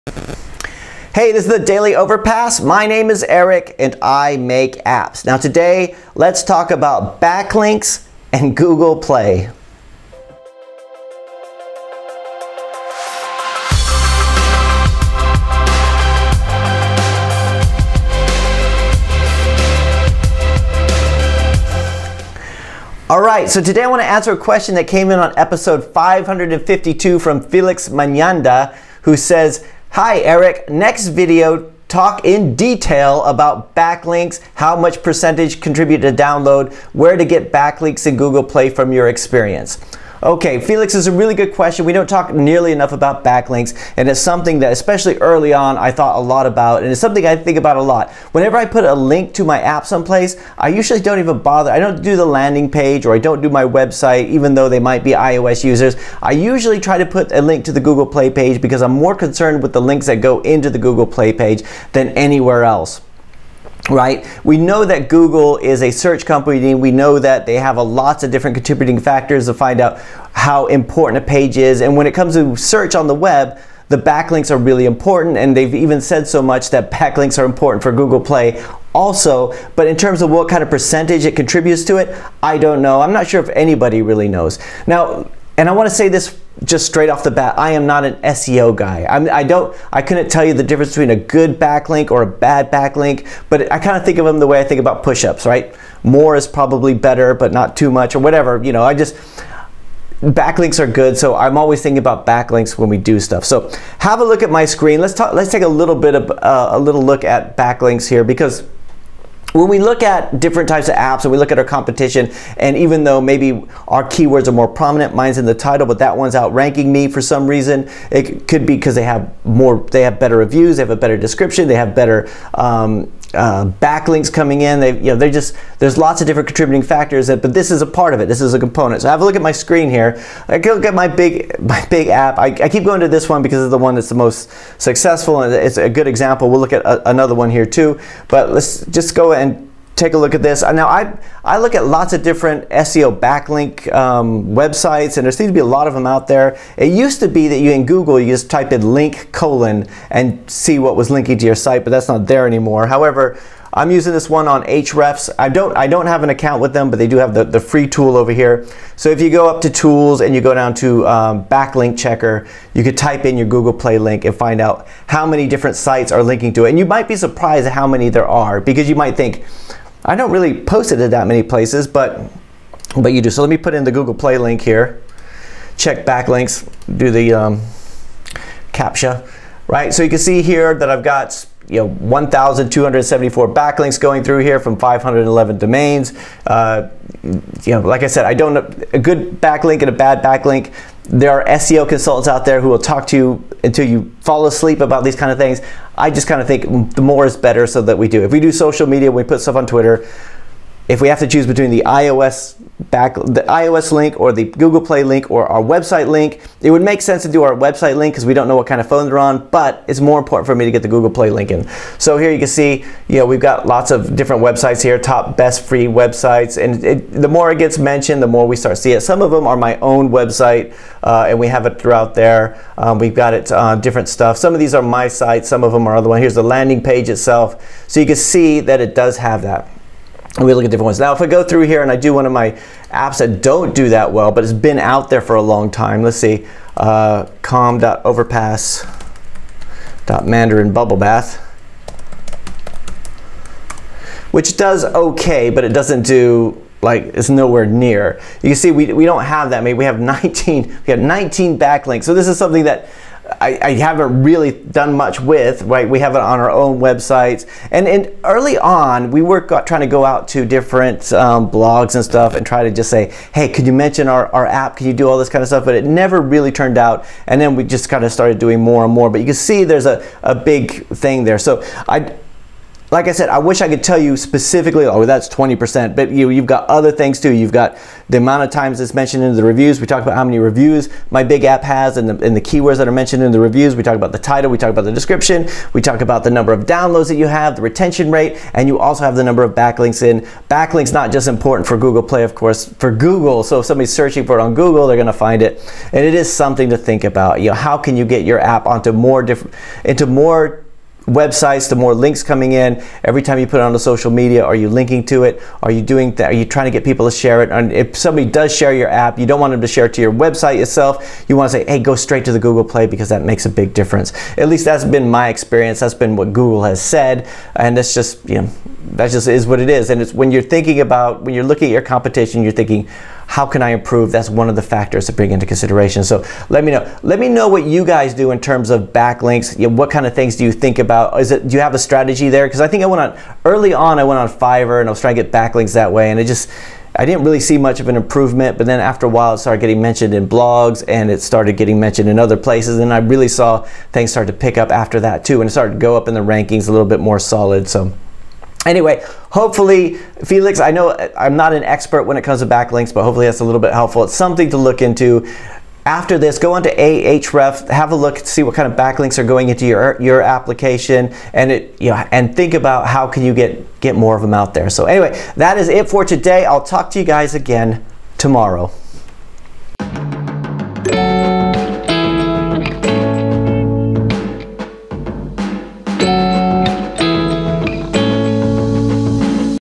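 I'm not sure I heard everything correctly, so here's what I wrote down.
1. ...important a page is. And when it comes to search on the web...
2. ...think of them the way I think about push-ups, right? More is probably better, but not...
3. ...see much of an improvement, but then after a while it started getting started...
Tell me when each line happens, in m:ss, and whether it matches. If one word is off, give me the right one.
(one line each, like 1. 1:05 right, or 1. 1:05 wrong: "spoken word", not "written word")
1. 1:10 right
2. 1:34 right
3. 5:37 wrong: "mentioned", not "started".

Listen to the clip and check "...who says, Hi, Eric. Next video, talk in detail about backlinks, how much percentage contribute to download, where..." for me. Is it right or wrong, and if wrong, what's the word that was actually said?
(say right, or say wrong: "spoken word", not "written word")
right.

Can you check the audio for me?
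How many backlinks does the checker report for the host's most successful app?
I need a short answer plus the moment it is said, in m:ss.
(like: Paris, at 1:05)
1,274, at 3:01.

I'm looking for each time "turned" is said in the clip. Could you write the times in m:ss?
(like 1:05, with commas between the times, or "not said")
4:26.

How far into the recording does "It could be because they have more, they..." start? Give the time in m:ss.
1:58.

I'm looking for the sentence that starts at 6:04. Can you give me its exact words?
So anyway, that is it for today.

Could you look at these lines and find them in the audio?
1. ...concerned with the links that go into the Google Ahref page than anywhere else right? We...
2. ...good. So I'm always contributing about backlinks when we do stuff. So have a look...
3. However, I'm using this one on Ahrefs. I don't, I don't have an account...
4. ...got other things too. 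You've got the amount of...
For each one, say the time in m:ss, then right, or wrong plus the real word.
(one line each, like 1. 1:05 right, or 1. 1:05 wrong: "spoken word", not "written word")
1. 0:59 wrong: "Play", not "Ahref"
2. 1:40 wrong: "thinking", not "contributing"
3. 2:32 right
4. 4:36 right.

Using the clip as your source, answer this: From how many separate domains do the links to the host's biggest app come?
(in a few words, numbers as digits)
511.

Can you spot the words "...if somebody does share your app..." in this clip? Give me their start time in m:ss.
5:07.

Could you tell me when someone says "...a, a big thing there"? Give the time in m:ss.
4:29.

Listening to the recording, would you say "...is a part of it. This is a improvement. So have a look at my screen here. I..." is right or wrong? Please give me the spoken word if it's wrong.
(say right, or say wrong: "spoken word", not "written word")
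wrong: "component", not "improvement".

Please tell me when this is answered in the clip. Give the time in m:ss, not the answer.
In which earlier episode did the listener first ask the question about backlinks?
0:25.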